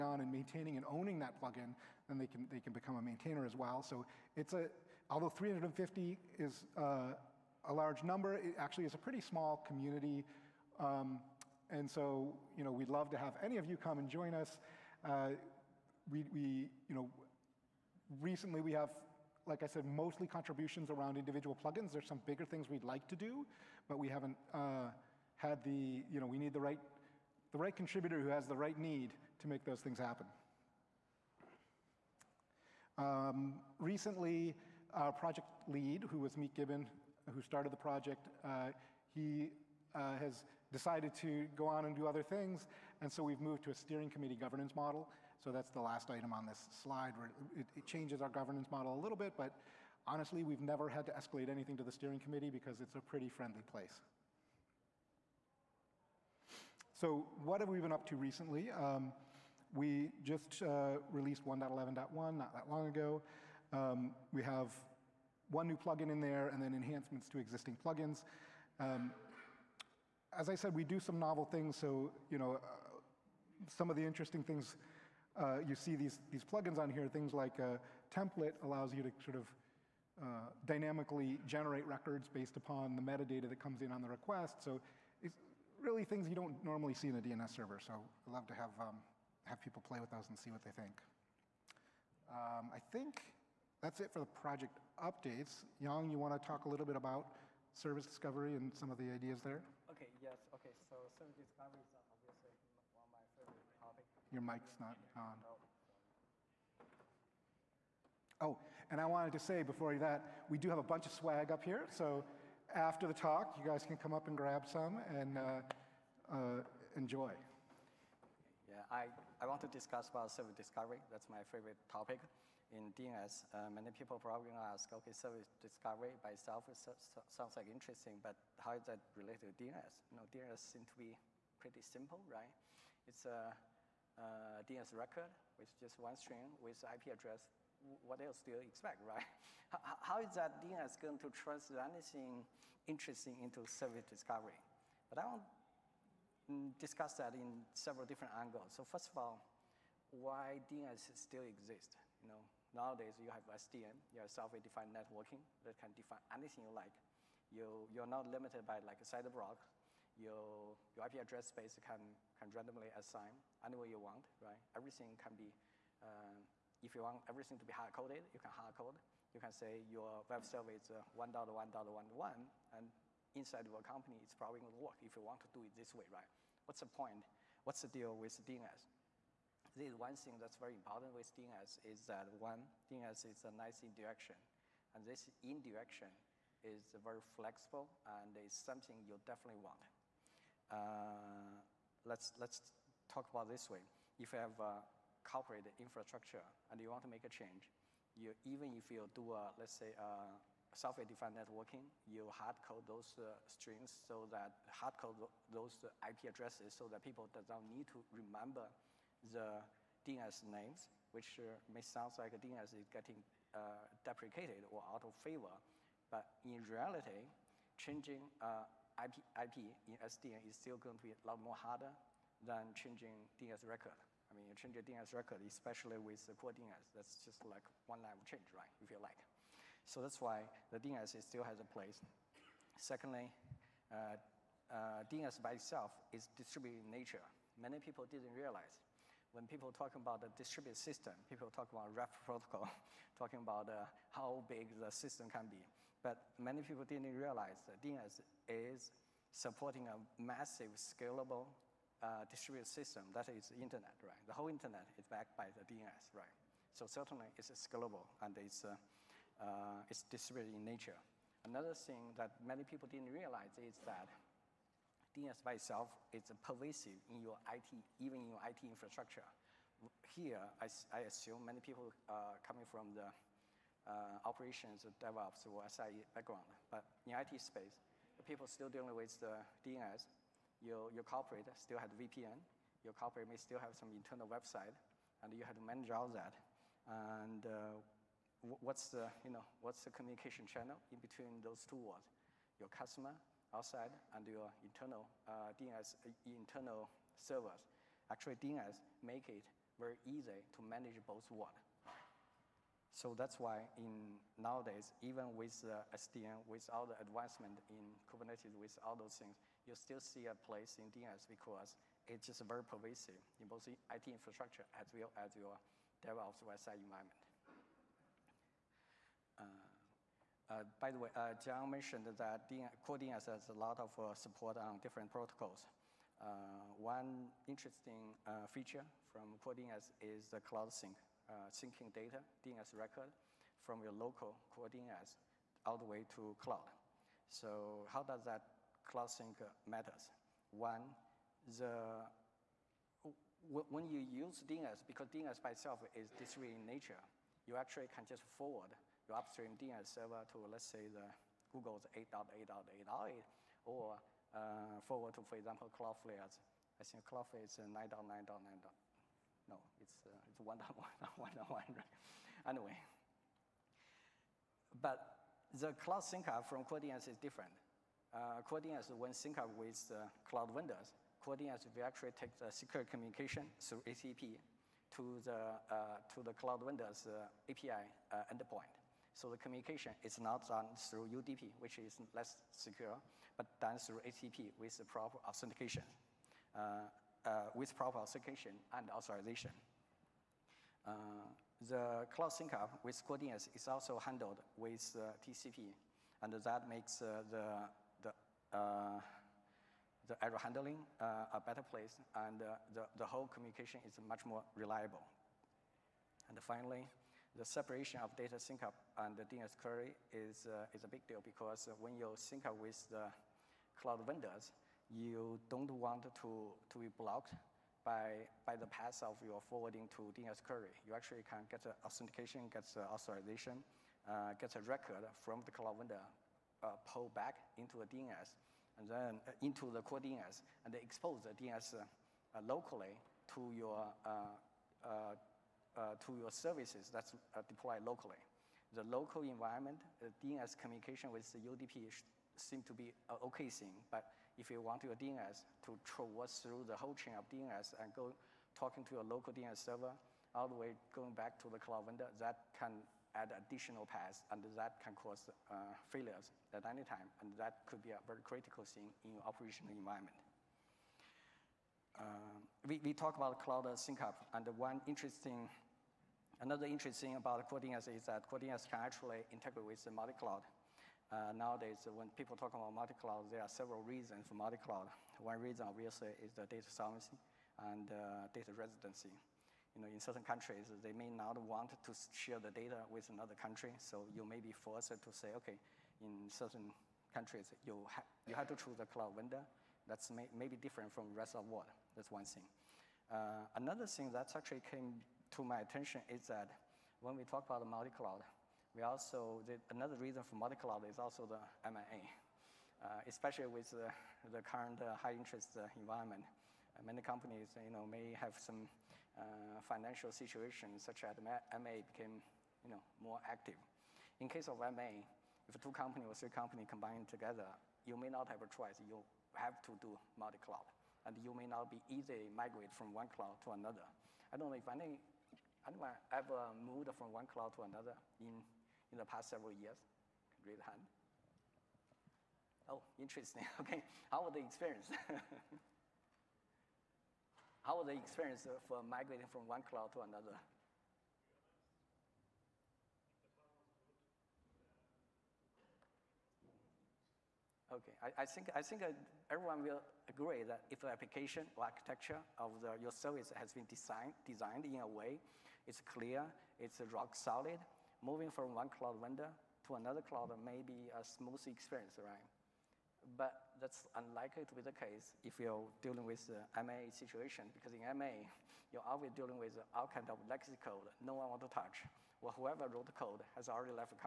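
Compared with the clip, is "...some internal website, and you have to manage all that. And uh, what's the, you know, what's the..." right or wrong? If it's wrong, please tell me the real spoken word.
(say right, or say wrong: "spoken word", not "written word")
right.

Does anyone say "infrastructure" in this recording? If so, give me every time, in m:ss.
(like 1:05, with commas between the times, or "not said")
3:15, 4:28, 5:14.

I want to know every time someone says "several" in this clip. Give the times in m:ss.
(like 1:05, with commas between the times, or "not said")
2:27, 7:53, 8:49.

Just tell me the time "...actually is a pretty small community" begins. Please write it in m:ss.
0:08.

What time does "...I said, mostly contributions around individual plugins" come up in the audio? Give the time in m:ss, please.
0:19.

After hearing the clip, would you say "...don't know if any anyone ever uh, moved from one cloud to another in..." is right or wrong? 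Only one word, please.
right.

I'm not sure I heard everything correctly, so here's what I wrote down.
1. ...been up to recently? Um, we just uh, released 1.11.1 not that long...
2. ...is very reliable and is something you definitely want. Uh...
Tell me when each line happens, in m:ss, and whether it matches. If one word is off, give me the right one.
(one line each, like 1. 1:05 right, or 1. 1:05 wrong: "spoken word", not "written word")
1. 0:57 right
2. 3:06 wrong: "flexible", not "reliable".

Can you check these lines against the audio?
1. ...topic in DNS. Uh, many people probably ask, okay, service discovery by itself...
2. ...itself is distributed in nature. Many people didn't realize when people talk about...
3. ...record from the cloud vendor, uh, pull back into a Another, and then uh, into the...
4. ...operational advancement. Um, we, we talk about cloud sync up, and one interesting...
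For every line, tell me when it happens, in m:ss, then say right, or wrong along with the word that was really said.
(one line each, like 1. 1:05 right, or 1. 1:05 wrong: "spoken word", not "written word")
1. 2:01 right
2. 3:55 right
3. 7:04 wrong: "DNS", not "Another"
4. 7:39 wrong: "environment", not "advancement".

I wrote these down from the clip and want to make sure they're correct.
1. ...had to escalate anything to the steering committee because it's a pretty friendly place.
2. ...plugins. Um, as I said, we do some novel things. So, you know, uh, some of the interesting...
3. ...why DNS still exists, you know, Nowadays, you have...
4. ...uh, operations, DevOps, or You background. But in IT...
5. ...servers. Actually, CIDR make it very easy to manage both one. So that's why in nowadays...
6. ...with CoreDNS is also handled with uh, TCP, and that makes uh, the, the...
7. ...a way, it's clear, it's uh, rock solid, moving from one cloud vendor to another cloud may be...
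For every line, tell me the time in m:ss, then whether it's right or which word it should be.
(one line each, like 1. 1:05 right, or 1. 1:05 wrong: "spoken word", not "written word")
1. 0:50 right
2. 1:07 right
3. 2:30 right
4. 4:33 wrong: "SRE", not "You"
5. 4:57 wrong: "DNS", not "CIDR"
6. 6:32 right
7. 9:14 right.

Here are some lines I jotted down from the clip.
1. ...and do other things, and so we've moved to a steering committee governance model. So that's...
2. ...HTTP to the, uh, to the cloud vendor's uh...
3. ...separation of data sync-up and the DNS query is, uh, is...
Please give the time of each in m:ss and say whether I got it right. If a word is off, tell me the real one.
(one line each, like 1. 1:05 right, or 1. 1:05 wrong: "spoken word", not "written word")
1. 0:41 right
2. 6:13 right
3. 6:47 right.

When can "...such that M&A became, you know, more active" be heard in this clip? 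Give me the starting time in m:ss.
8:30.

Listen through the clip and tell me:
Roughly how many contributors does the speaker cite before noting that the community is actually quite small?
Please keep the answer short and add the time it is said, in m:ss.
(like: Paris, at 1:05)
350, at 0:05.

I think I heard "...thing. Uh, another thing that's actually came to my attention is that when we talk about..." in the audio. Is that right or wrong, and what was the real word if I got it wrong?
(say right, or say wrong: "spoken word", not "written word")
right.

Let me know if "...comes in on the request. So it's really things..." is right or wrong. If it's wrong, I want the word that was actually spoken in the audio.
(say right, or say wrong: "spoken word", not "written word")
right.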